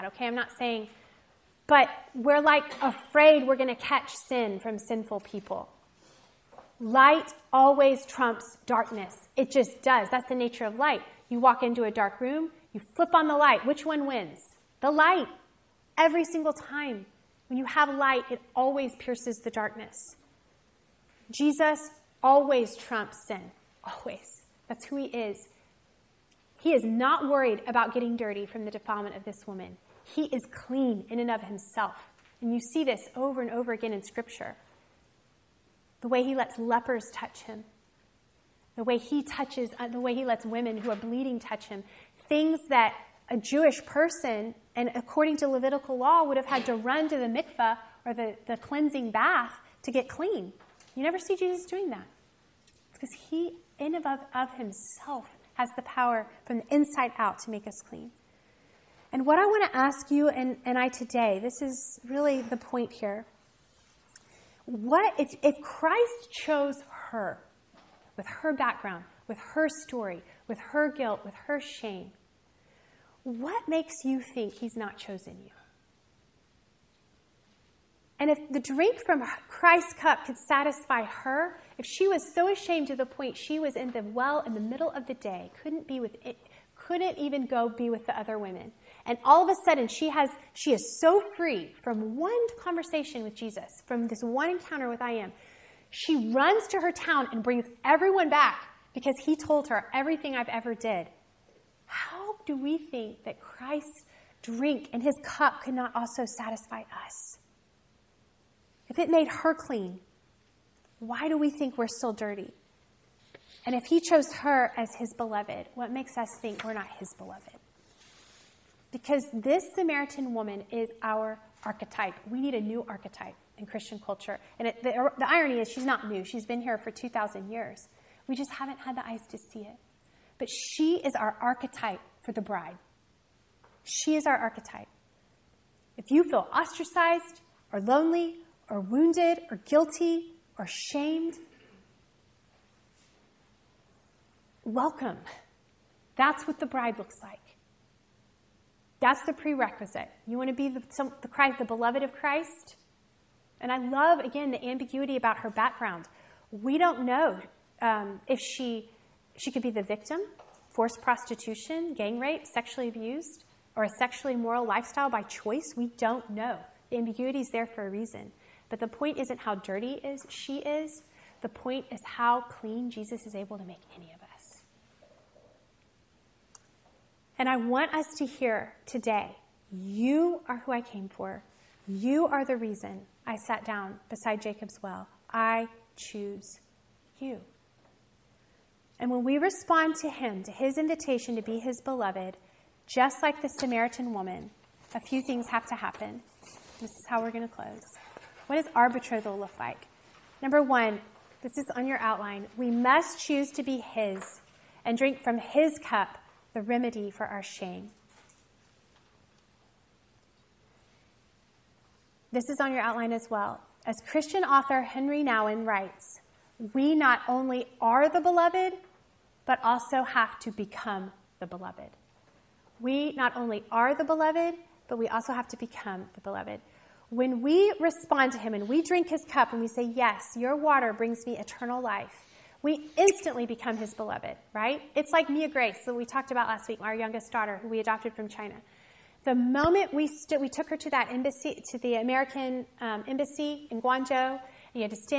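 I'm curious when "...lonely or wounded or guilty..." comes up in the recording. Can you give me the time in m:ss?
2:17.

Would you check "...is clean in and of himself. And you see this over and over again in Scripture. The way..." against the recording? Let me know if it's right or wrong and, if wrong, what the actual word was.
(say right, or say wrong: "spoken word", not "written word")
right.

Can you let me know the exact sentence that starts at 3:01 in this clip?
You are the reason I sat down beside Jacob's well.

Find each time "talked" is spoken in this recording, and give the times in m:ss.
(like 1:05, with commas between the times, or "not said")
3:56.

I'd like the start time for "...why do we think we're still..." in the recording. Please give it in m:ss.
1:50.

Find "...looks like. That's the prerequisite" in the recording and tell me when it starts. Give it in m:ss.
2:26.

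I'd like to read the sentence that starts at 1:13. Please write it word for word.
What makes you think he's not chosen you?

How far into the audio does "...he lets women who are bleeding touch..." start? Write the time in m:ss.
0:40.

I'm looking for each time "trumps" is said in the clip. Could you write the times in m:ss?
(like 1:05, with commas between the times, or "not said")
0:08, 0:22.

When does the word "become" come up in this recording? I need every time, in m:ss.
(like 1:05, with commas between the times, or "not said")
3:40, 3:45, 3:53.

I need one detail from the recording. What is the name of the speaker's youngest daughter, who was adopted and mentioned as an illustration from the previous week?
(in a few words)
Mia Grace.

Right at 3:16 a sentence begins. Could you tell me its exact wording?
This is how we're going to close.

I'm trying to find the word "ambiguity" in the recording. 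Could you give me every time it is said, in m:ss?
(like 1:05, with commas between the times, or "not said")
2:34, 2:46.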